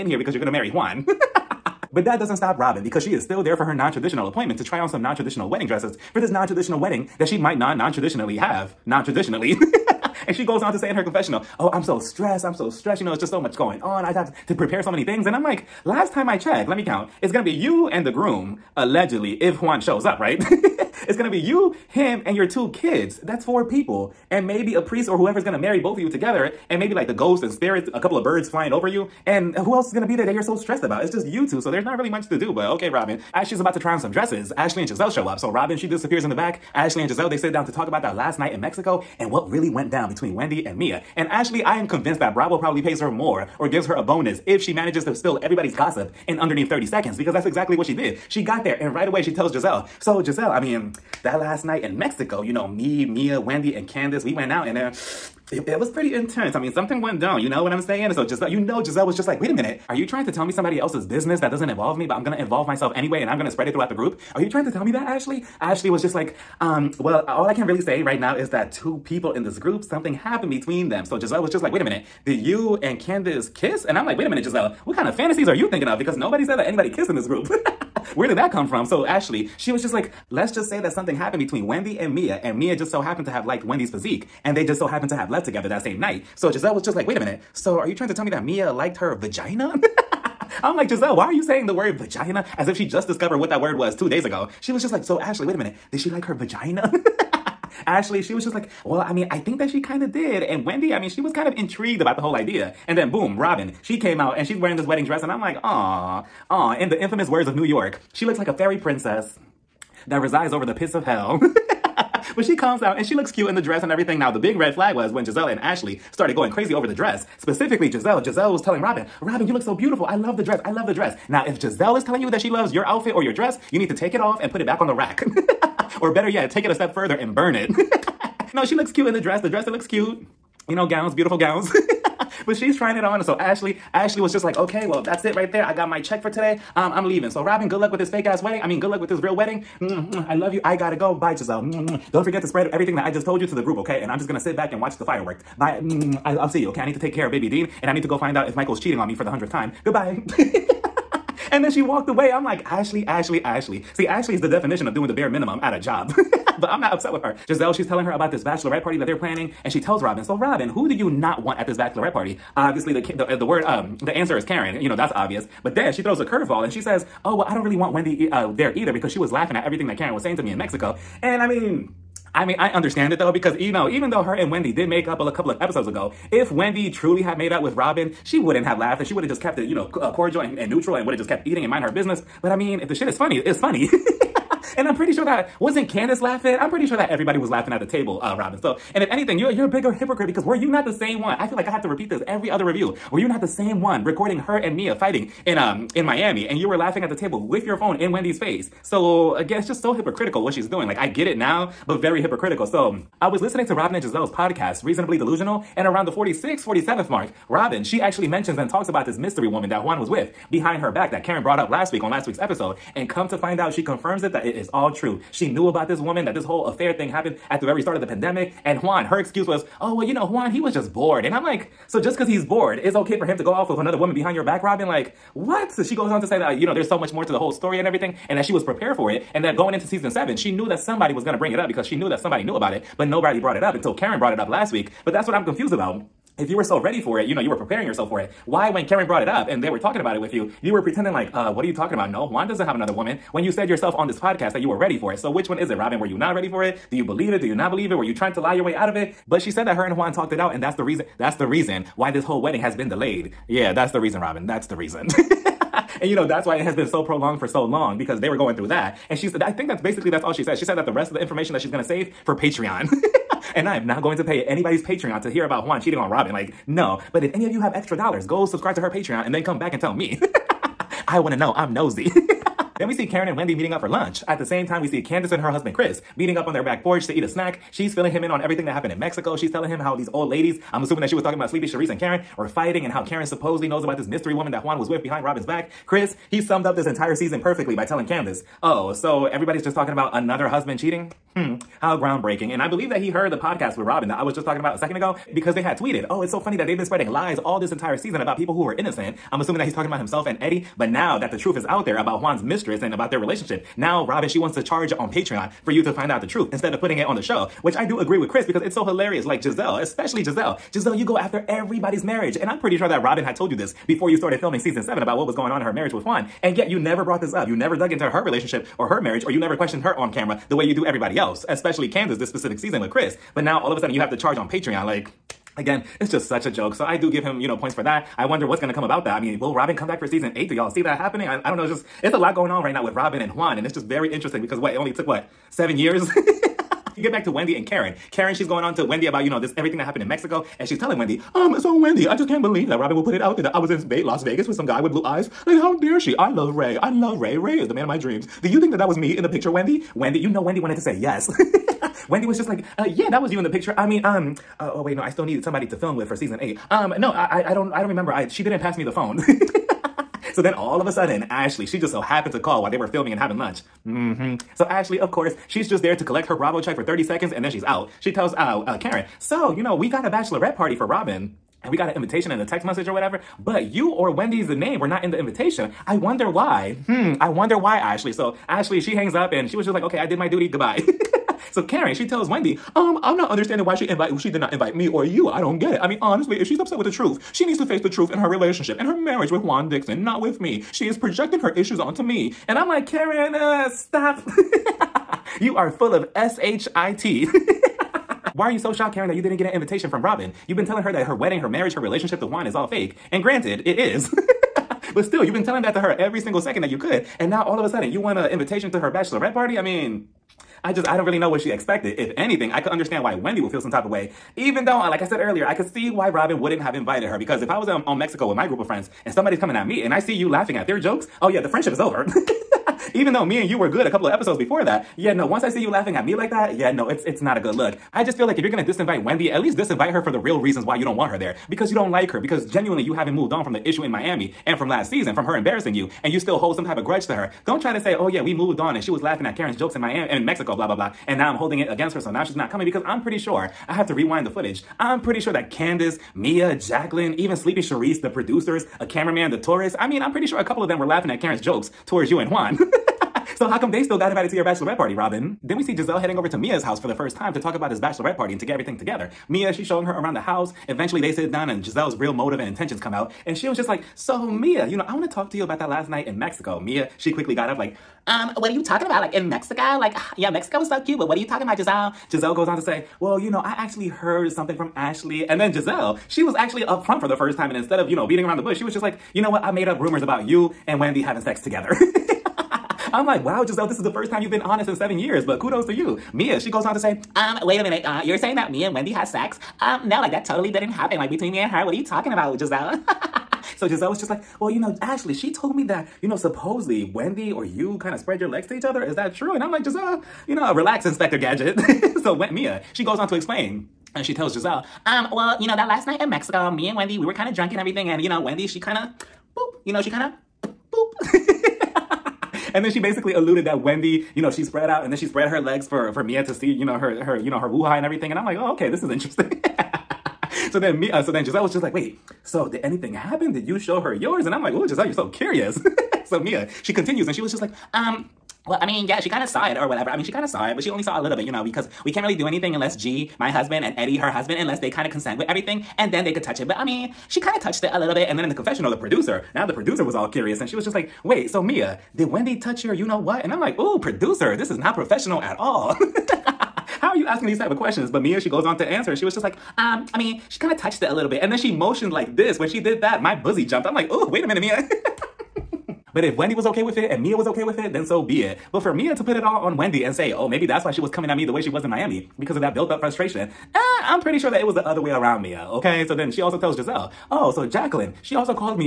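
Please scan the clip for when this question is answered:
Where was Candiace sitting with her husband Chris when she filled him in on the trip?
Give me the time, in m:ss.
4:36.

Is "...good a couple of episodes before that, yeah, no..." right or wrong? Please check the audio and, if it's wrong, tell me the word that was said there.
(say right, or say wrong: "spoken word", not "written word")
right.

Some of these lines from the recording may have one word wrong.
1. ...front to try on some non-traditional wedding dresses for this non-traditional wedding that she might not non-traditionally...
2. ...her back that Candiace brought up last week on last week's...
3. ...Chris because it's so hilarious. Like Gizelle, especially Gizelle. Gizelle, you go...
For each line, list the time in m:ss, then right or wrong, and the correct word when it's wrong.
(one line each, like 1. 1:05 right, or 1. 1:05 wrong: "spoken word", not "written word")
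1. 0:04 wrong: "appointment", not "front"
2. 3:30 wrong: "Karen", not "Candiace"
3. 5:08 right.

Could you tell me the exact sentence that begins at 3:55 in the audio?
But that's what I'm confused about if you were so ready for it, you know, you were preparing yourself for it.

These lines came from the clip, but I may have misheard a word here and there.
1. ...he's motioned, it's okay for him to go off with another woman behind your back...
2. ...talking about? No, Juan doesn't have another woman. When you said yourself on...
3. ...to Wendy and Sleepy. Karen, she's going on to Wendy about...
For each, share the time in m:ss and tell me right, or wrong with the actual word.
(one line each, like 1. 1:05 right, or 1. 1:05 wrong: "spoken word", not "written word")
1. 3:42 wrong: "bored", not "motioned"
2. 4:01 right
3. 5:37 wrong: "Karen", not "Sleepy".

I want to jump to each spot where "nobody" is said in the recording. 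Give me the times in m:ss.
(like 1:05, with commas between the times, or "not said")
1:16, 3:53.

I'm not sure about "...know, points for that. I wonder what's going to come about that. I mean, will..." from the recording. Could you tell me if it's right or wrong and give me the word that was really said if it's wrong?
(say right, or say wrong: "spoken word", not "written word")
right.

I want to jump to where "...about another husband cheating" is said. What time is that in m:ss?
4:49.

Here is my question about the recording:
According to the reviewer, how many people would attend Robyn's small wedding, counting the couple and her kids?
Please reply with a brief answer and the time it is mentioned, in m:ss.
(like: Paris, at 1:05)
4, at 0:23.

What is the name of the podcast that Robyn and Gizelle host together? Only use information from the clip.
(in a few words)
Reasonably Delusional.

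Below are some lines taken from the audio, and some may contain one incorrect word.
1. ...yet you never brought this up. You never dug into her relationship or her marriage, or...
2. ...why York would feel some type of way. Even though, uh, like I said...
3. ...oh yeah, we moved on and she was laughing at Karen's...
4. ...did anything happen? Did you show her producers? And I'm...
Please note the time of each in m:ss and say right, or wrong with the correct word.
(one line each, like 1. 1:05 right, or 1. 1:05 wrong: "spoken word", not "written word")
1. 5:16 right
2. 6:53 wrong: "Wendy", not "York"
3. 7:17 right
4. 8:42 wrong: "yours", not "producers".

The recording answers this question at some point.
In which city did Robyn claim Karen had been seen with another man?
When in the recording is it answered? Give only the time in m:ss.
5:44.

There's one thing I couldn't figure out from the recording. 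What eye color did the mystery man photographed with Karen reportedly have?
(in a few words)
Blue.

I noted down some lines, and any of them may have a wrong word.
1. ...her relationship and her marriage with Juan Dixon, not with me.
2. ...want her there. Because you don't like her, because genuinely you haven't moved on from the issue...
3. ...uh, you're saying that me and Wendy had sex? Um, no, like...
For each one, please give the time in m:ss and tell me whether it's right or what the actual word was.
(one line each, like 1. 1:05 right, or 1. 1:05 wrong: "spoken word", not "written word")
1. 6:28 right
2. 7:10 right
3. 8:07 right.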